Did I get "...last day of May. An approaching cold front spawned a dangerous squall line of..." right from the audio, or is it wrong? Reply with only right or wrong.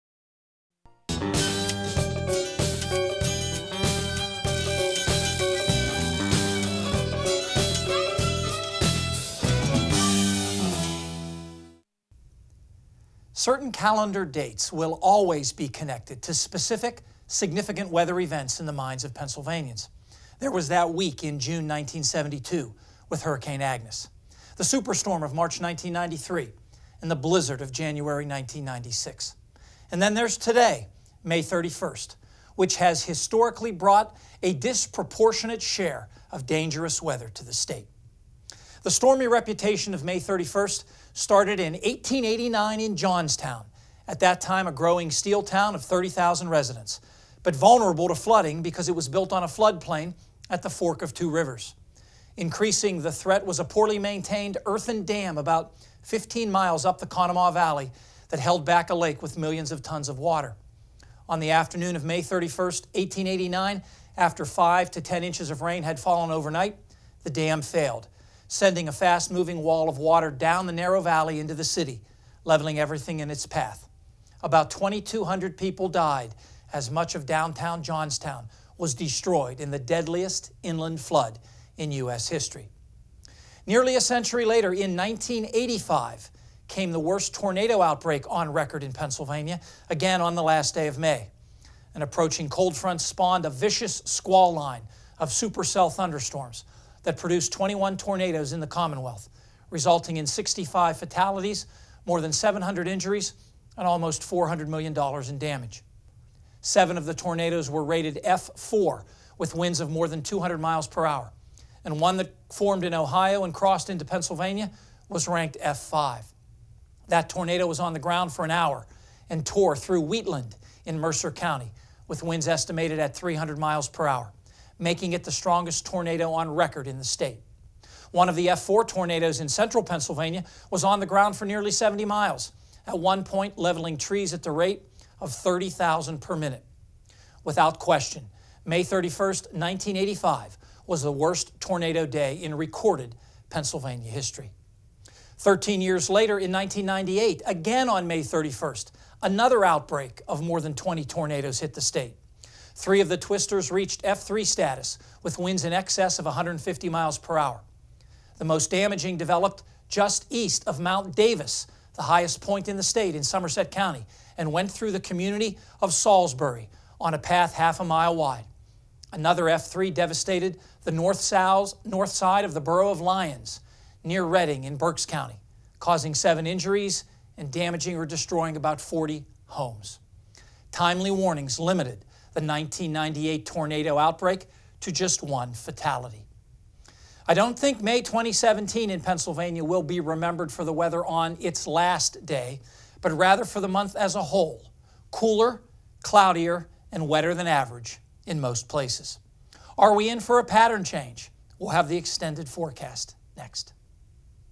wrong.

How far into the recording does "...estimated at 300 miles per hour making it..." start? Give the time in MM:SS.
02:02.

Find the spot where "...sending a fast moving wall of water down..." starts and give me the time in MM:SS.
01:08.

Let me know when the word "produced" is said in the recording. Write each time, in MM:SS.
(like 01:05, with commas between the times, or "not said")
01:37.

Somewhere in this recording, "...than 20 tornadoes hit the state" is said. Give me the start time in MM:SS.
02:30.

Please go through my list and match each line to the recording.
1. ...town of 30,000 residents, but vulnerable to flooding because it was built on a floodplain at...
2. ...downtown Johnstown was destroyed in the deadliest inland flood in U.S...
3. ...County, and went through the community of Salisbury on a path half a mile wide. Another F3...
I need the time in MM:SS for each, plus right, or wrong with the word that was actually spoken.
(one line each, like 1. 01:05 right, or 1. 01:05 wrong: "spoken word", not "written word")
1. 00:45 right
2. 01:17 right
3. 02:43 right.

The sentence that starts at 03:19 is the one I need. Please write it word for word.
Are we in for a pattern change?